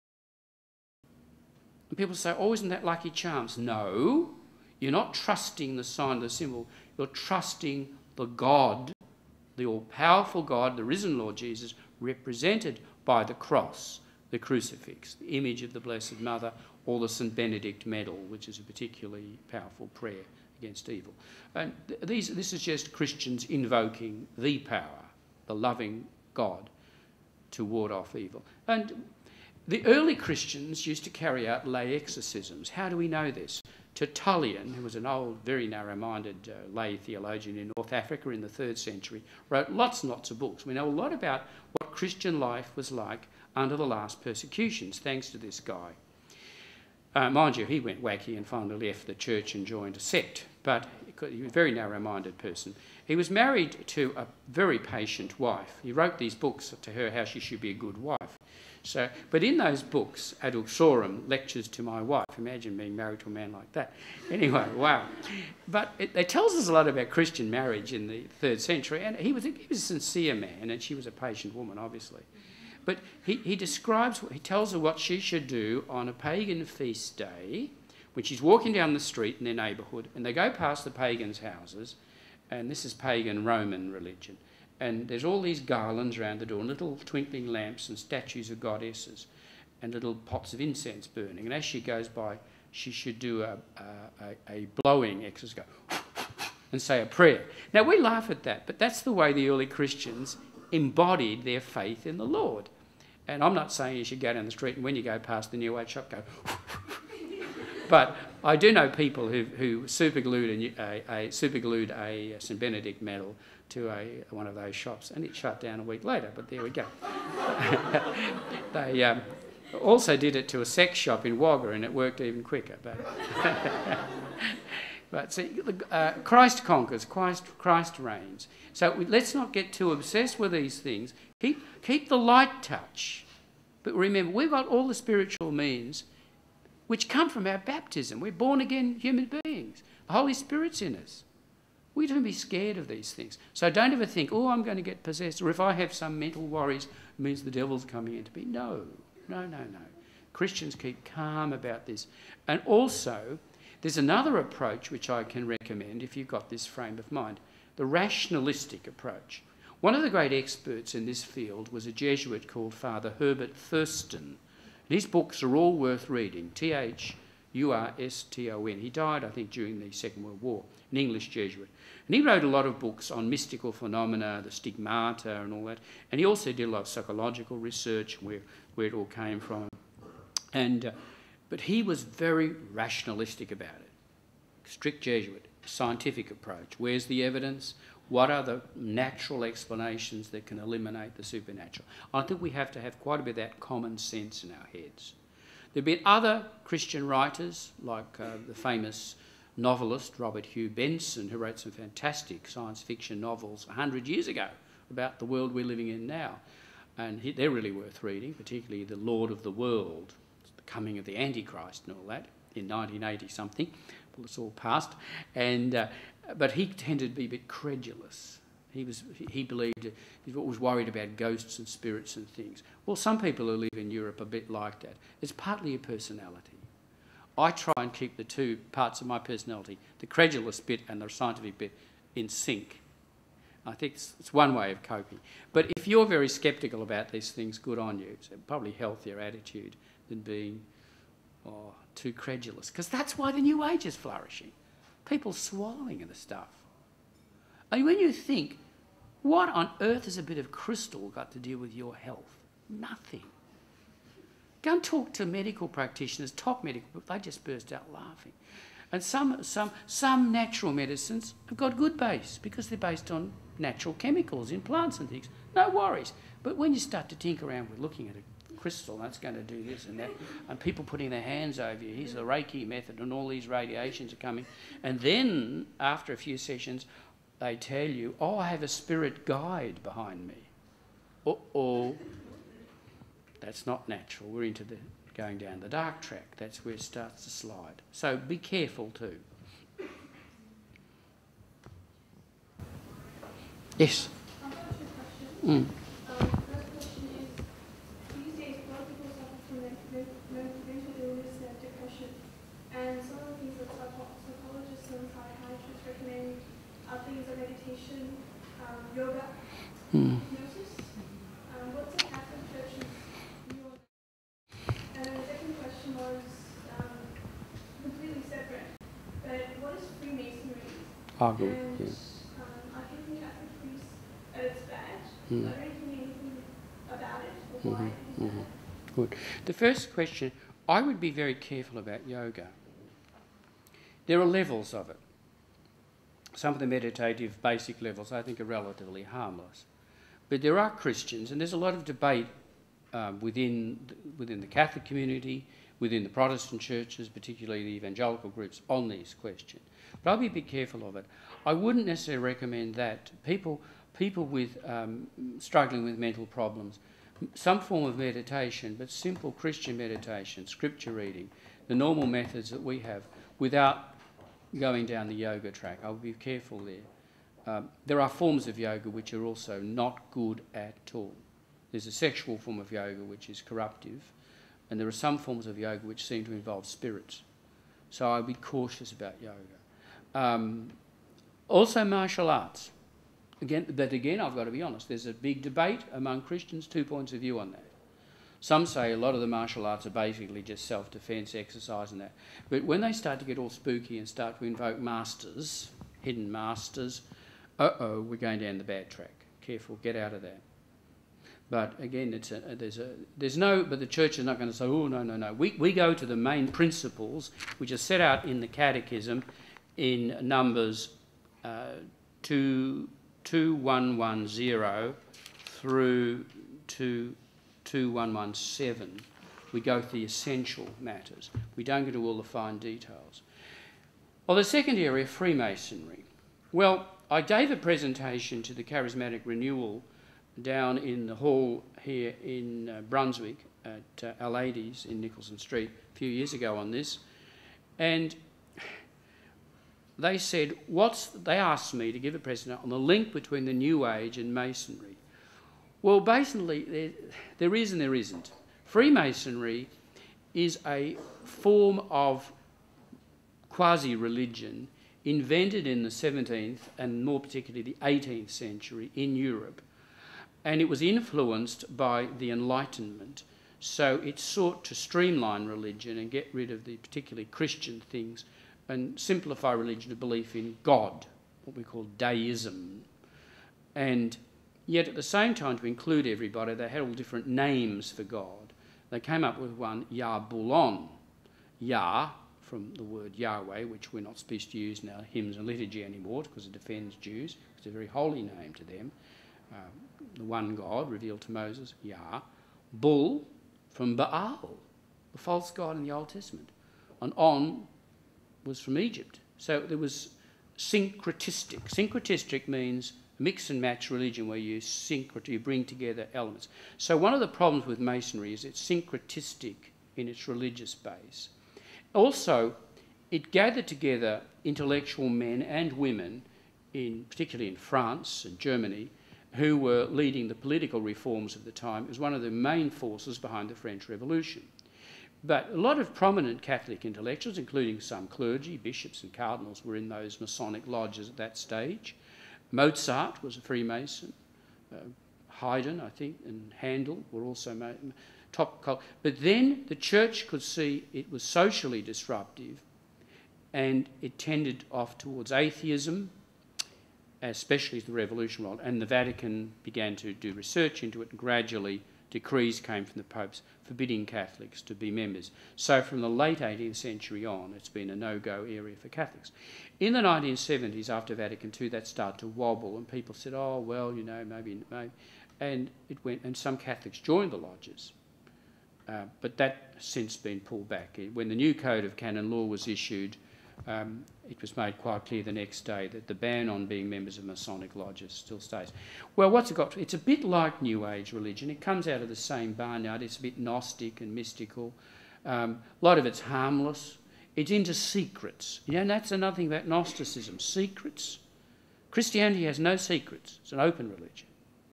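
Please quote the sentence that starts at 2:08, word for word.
So we, let's not get too obsessed with these things.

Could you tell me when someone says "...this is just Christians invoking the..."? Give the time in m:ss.
0:22.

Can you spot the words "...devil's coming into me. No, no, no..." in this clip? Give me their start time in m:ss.
2:27.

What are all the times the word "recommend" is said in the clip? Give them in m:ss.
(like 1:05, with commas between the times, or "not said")
2:35, 5:52.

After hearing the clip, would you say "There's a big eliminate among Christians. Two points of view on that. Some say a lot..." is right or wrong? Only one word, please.
wrong.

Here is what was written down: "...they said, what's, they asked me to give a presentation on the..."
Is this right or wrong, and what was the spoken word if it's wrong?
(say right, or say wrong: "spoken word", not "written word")
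right.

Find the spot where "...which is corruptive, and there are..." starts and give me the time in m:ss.
6:13.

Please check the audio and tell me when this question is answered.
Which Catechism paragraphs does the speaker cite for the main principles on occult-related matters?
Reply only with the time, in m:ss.
6:52.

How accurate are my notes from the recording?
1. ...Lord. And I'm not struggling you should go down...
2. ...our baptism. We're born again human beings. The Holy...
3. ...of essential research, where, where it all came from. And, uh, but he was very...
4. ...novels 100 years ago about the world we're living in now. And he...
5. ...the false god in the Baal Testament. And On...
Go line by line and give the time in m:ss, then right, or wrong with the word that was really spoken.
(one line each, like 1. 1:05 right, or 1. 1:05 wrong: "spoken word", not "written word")
1. 1:42 wrong: "saying", not "struggling"
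2. 2:17 right
3. 2:56 wrong: "psychological", not "essential"
4. 3:23 right
5. 8:15 wrong: "Old", not "Baal".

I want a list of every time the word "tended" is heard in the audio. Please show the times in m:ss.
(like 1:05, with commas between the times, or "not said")
3:36, 9:04.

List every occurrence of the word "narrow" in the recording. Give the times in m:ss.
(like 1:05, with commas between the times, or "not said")
0:35, 0:51.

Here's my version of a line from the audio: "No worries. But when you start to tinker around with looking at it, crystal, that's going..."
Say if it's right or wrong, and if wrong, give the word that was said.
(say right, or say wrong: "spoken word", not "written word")
right.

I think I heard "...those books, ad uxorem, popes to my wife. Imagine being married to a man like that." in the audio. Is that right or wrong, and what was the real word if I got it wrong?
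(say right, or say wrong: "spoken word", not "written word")
wrong: "lectures", not "popes".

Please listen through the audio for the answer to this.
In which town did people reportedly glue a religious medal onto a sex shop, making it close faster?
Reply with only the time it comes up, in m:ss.
2:01.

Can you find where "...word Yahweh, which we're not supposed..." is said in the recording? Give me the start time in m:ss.
8:02.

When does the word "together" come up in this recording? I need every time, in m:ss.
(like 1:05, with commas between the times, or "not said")
8:25, 8:33.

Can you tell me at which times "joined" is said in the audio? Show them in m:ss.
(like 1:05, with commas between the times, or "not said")
0:49, 9:26.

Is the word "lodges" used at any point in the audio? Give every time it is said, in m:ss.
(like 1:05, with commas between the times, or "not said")
8:50, 9:27, 9:37.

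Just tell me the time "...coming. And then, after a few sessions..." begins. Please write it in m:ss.
4:34.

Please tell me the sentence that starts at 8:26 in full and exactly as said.
So one of the problems with Masonry is it's syncretistic in its religious base.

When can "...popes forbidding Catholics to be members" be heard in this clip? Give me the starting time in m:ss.
9:13.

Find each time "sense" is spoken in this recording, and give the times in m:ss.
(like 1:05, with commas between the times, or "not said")
3:13.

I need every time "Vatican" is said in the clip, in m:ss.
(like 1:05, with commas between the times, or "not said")
9:08, 9:21.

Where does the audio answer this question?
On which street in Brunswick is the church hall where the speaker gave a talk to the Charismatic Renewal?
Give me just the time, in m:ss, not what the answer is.
7:15.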